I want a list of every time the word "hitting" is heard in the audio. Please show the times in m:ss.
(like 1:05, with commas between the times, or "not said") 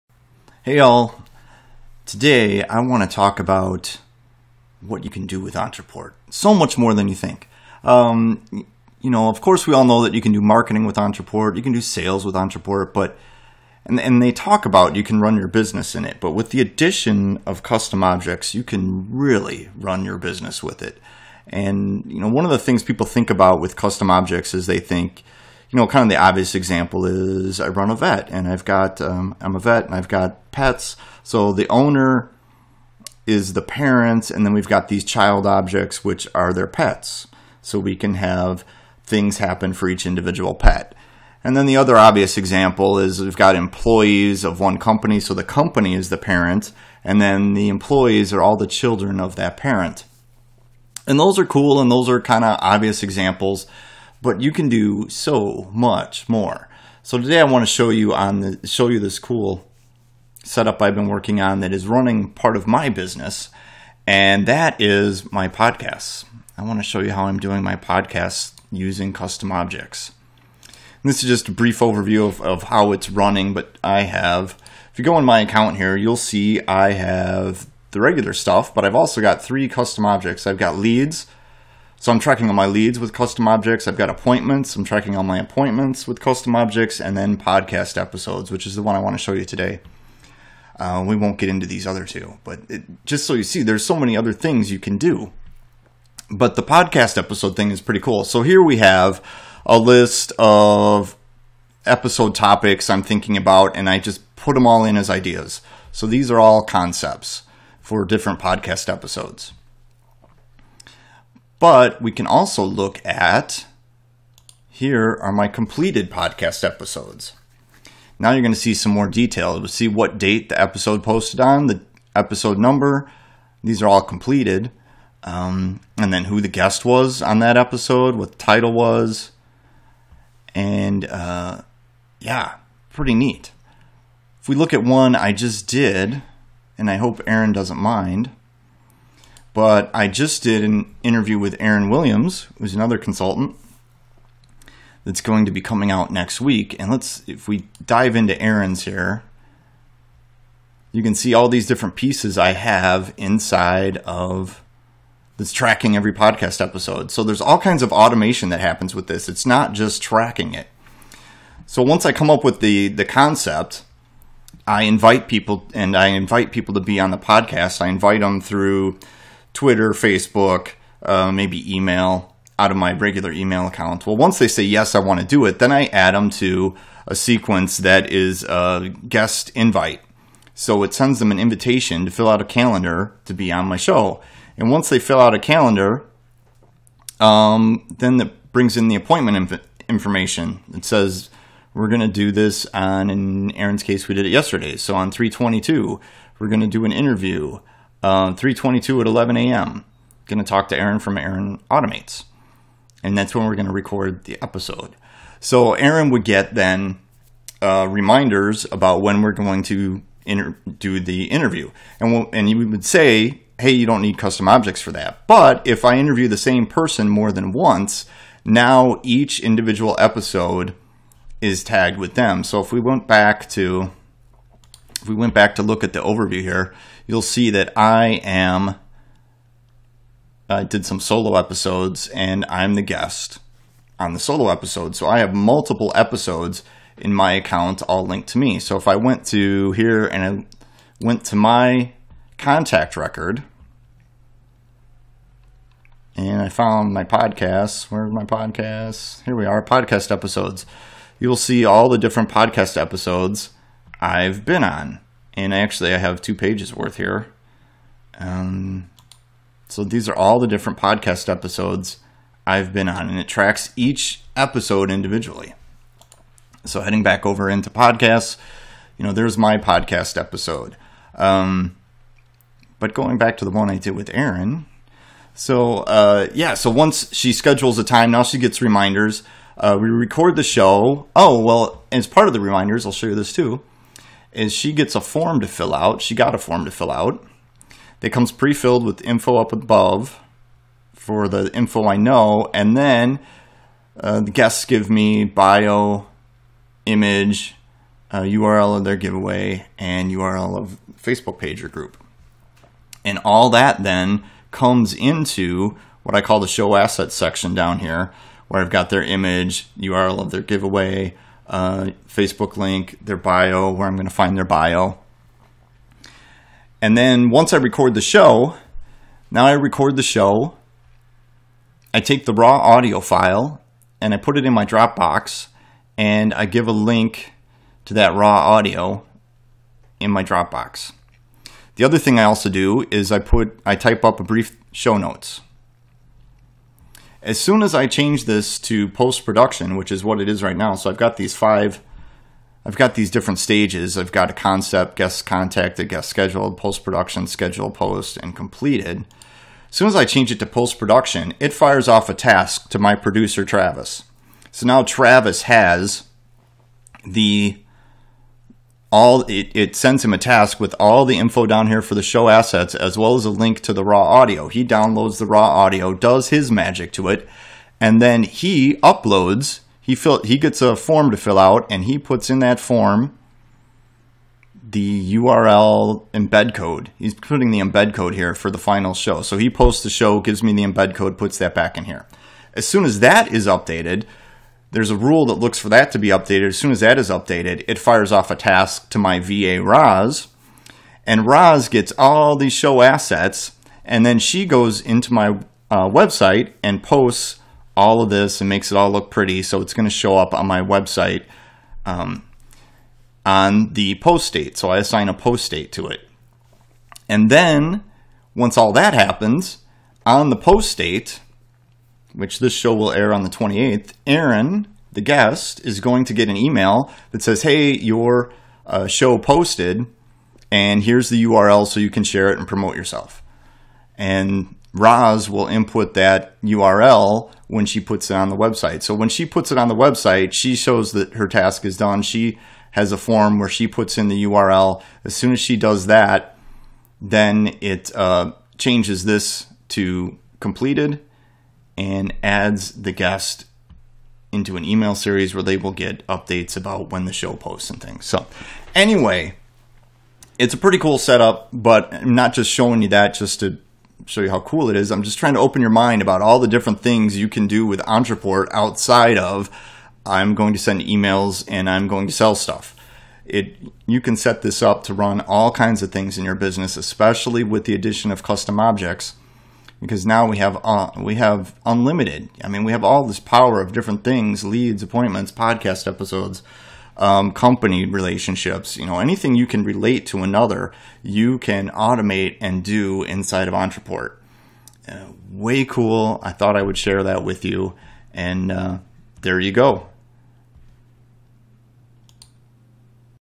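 not said.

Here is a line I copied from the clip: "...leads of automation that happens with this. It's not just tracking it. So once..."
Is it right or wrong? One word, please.
wrong.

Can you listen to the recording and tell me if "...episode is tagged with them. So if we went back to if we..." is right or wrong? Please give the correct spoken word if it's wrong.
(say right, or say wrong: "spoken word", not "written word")
right.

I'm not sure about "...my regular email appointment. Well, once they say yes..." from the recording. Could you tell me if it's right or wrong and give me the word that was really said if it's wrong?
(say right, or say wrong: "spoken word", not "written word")
wrong: "account", not "appointment".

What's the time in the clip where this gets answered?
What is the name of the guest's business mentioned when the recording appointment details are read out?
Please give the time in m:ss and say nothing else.
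3:21.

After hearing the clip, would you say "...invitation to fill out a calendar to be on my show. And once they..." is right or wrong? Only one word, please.
right.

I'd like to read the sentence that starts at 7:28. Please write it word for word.
So, anyway, it's a pretty cool setup, but I'm not just showing you that just to show you how cool it is.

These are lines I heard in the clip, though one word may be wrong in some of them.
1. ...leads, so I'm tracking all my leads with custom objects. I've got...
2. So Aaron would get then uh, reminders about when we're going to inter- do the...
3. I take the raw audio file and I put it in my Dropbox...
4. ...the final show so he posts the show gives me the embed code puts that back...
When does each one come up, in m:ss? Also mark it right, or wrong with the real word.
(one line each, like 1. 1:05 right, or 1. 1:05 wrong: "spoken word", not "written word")
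1. 1:20 right
2. 3:25 right
3. 5:21 right
4. 6:18 right.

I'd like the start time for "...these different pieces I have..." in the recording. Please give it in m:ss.
2:31.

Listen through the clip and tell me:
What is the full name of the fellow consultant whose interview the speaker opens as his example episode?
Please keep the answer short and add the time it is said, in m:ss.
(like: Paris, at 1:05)
Aaron Williams, at 2:21.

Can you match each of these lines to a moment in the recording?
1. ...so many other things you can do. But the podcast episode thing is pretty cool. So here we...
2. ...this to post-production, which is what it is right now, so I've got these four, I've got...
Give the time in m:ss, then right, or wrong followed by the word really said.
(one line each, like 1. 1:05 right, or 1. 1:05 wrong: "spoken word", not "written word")
1. 1:33 right
2. 5:38 wrong: "five", not "four".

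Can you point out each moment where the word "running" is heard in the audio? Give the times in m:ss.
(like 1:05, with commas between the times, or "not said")
1:01, 1:13.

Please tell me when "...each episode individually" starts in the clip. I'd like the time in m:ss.
4:23.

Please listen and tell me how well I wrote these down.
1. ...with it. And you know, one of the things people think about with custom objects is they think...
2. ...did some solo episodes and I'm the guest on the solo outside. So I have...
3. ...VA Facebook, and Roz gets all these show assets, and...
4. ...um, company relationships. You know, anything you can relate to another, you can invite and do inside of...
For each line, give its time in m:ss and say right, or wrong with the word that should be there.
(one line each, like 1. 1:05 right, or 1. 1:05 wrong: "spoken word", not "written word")
1. 0:20 right
2. 3:50 wrong: "episode", not "outside"
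3. 6:29 wrong: "Roz", not "Facebook"
4. 7:56 wrong: "automate", not "invite".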